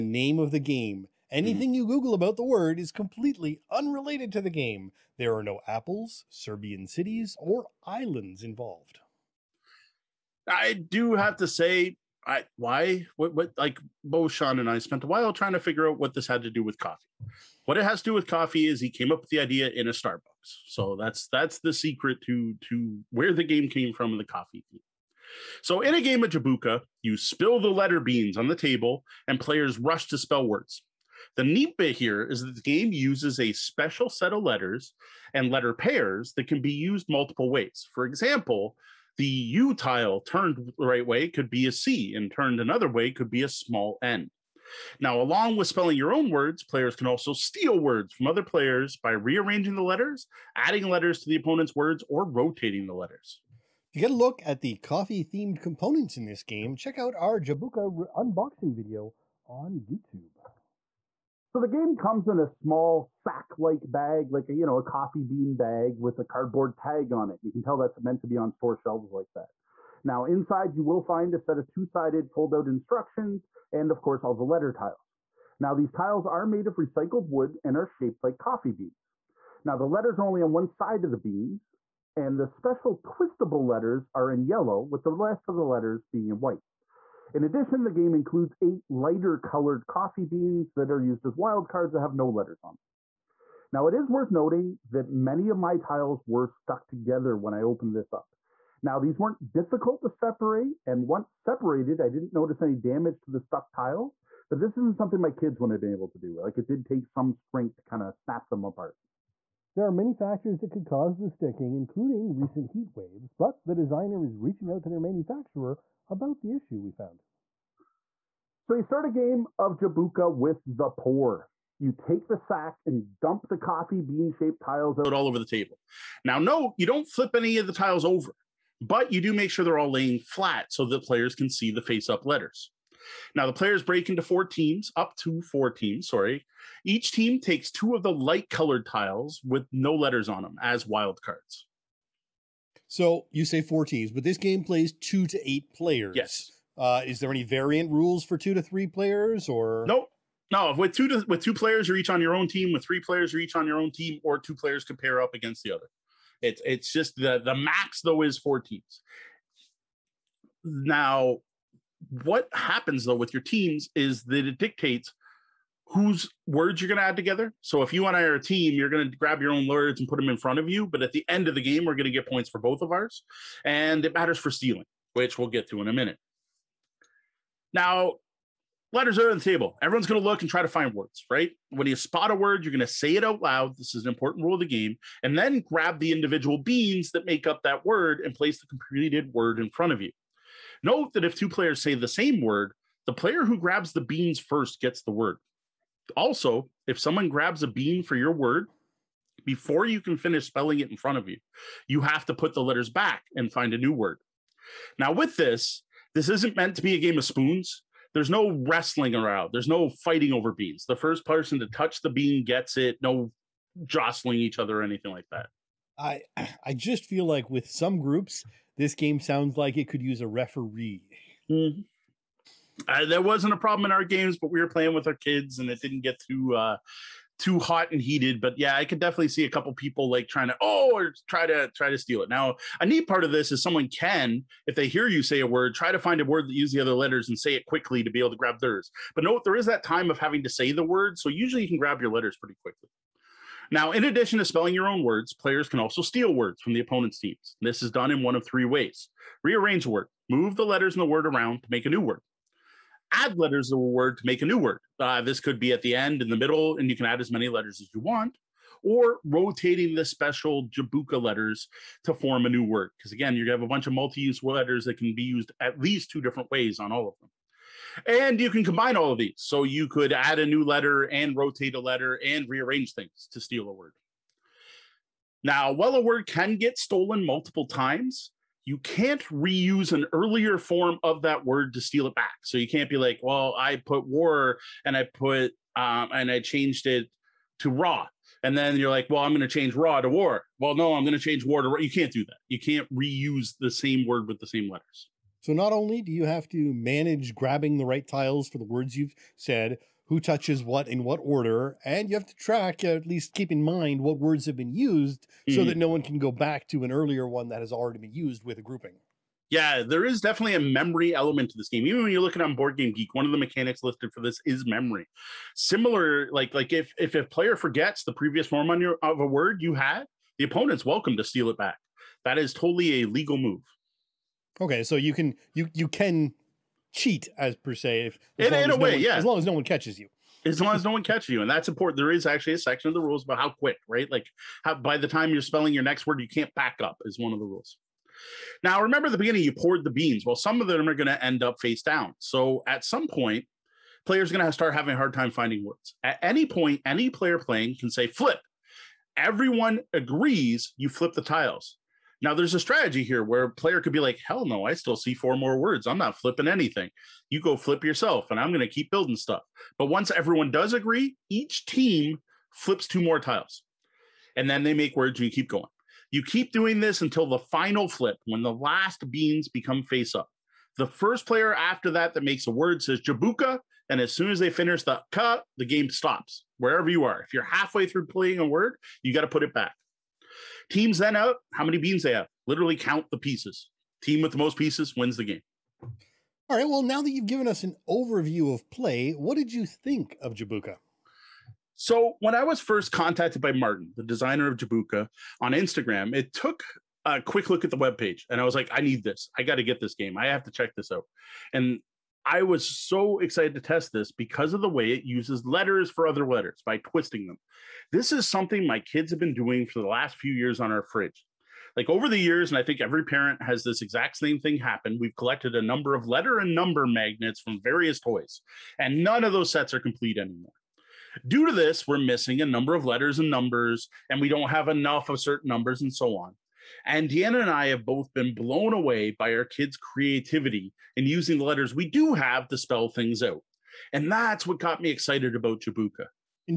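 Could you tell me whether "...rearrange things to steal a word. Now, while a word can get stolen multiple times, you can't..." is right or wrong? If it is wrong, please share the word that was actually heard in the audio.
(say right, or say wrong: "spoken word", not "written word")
right.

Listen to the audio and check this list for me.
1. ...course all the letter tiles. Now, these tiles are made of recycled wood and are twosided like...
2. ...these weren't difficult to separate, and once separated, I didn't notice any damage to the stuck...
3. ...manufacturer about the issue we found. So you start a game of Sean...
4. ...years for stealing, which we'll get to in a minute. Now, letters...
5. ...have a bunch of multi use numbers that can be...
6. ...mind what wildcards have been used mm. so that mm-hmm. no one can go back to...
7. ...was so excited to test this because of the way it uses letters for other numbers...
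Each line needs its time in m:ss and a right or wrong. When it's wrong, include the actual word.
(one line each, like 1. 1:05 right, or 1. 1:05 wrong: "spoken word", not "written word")
1. 1:14 wrong: "shaped", not "twosided"
2. 1:38 right
3. 1:54 wrong: "Jabuka", not "Sean"
4. 2:54 wrong: "matters", not "years"
5. 4:23 wrong: "letters", not "numbers"
6. 5:03 wrong: "words", not "wildcards"
7. 6:42 wrong: "letters", not "numbers".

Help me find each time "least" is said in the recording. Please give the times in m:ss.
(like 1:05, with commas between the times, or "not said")
4:25, 5:03.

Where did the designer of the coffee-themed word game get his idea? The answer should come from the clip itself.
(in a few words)
Starbucks.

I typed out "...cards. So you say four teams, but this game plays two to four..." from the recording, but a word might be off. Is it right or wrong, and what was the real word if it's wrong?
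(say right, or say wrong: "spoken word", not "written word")
wrong: "eight", not "four".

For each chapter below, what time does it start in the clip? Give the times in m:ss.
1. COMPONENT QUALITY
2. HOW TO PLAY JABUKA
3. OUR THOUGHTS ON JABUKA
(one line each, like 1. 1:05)
1. 0:53
2. 1:58
3. 6:25.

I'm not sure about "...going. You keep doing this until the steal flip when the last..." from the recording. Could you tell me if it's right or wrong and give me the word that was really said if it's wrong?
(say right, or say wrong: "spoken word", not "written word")
wrong: "final", not "steal".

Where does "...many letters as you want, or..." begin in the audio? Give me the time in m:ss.
4:17.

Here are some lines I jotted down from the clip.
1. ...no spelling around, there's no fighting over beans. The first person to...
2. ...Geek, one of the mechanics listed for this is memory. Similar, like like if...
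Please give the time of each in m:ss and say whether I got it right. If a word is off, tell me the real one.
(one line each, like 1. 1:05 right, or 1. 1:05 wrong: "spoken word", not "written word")
1. 3:28 wrong: "wrestling", not "spelling"
2. 5:12 right.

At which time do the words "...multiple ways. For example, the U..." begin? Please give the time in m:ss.
0:37.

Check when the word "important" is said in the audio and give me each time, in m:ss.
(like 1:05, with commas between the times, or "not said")
3:04, 5:31.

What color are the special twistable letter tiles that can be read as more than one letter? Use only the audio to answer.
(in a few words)
Yellow.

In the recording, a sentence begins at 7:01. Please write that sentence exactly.
Due to this, we're missing a number of letters and numbers, and we don't have enough of certain numbers and so on.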